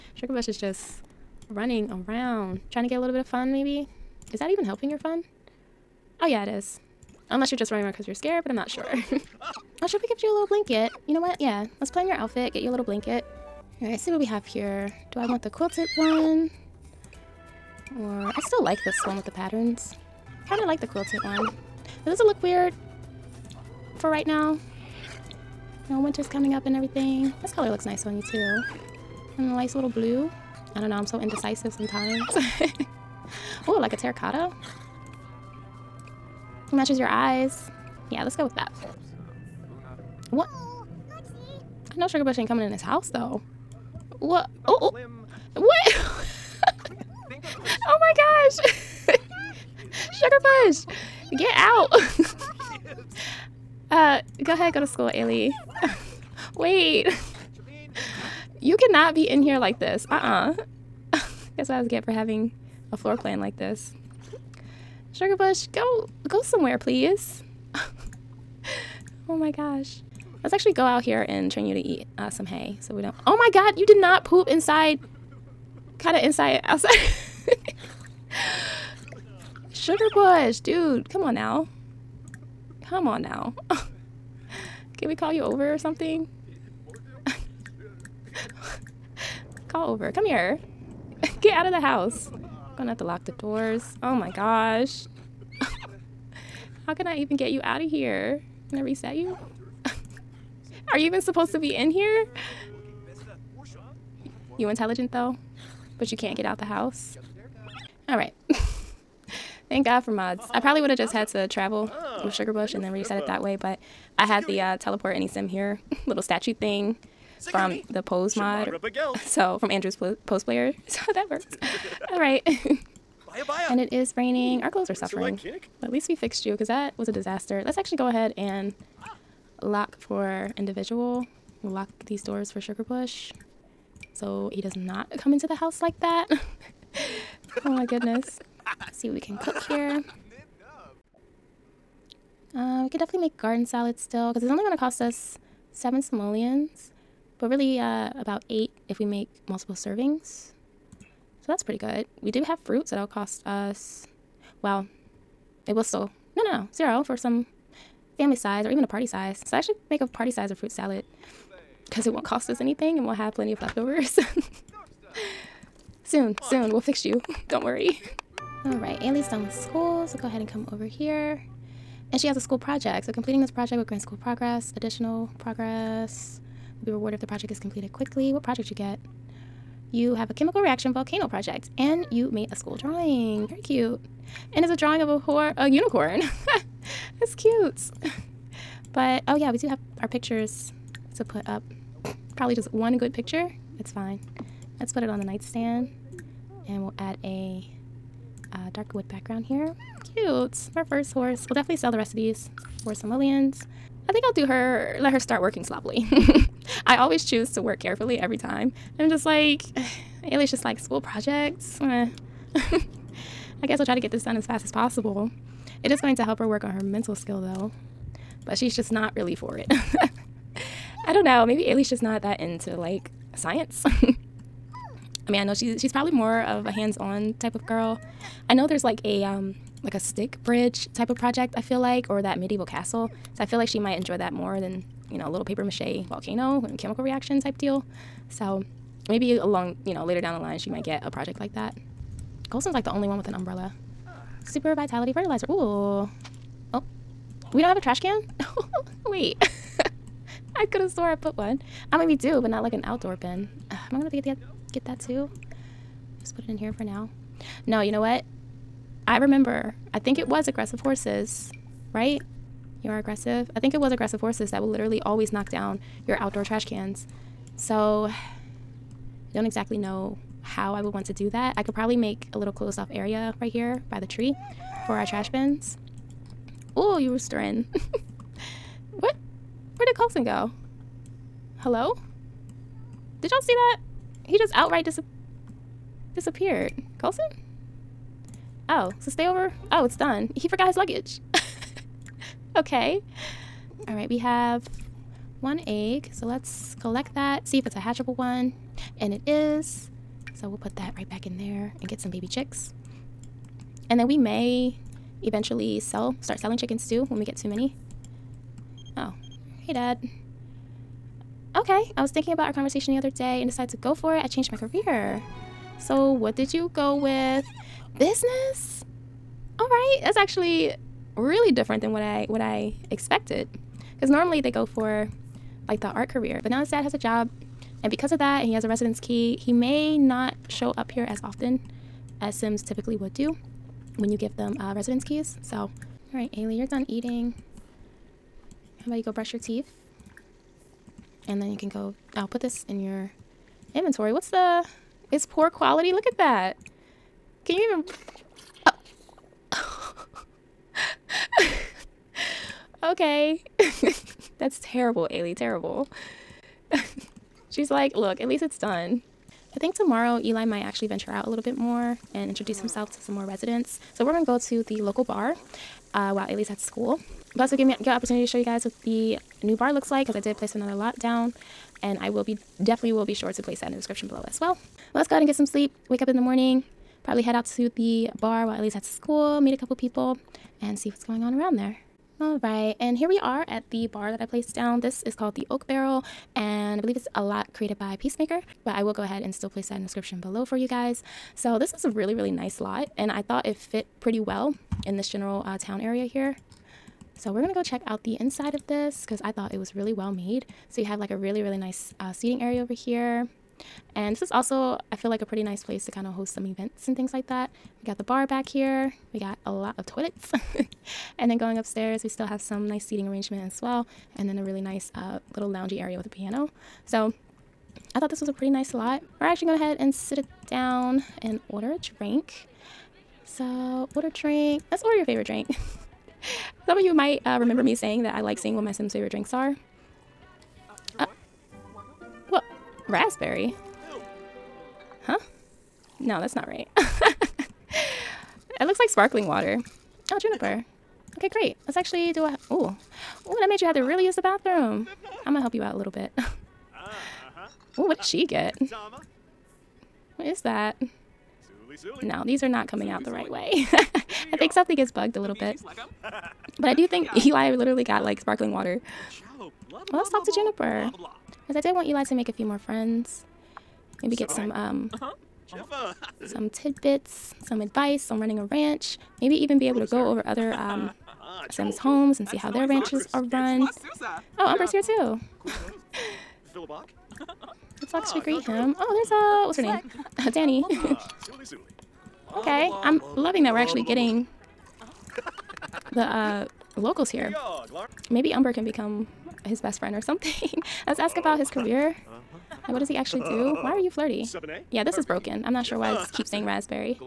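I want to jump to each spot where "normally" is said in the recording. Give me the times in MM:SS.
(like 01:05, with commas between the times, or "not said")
05:24.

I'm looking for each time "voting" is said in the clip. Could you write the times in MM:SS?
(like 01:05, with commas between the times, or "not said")
not said.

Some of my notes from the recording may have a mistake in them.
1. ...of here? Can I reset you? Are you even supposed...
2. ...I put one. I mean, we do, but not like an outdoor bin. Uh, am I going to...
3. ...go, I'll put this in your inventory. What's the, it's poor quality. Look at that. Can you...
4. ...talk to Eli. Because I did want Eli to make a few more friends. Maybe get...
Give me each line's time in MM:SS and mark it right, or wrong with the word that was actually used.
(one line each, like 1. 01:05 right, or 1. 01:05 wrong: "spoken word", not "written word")
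1. 01:37 right
2. 04:11 right
3. 05:41 right
4. 07:40 wrong: "Juniper", not "Eli".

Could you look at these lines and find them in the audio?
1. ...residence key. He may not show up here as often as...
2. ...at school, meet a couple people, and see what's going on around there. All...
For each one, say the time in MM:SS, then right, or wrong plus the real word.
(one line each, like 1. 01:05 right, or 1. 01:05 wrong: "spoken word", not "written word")
1. 05:28 right
2. 06:18 right.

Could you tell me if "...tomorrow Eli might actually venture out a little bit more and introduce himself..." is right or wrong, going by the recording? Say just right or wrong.
right.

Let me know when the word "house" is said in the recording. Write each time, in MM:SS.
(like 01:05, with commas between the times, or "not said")
00:42, 01:31, 01:46, 02:15.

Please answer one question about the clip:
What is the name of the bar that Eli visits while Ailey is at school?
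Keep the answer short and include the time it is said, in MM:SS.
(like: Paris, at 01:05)
The Oak Barrel, at 06:25.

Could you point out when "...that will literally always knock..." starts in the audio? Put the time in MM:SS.
04:24.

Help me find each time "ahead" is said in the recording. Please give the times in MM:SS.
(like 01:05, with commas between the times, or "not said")
00:54, 02:08, 02:50, 06:15, 06:29.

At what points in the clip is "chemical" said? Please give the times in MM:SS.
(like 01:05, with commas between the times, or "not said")
03:00, 03:56.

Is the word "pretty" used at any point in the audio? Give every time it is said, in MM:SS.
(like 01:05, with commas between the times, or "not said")
02:31, 06:34, 06:45, 06:58.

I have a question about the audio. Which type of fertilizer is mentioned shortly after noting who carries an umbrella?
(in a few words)
Super Vitality Fertilizer.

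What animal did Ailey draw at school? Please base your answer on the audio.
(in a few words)
Unicorn.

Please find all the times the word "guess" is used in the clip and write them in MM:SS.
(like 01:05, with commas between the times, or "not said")
01:01, 03:33.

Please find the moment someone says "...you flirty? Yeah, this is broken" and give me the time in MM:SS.
08:13.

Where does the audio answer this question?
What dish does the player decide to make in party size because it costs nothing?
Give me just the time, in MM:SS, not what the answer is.
02:40.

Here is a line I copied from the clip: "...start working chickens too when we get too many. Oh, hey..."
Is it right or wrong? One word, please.
wrong.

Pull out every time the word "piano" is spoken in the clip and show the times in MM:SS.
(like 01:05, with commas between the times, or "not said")
06:56.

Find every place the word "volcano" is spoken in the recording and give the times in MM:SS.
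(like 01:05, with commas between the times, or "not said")
03:00, 03:56.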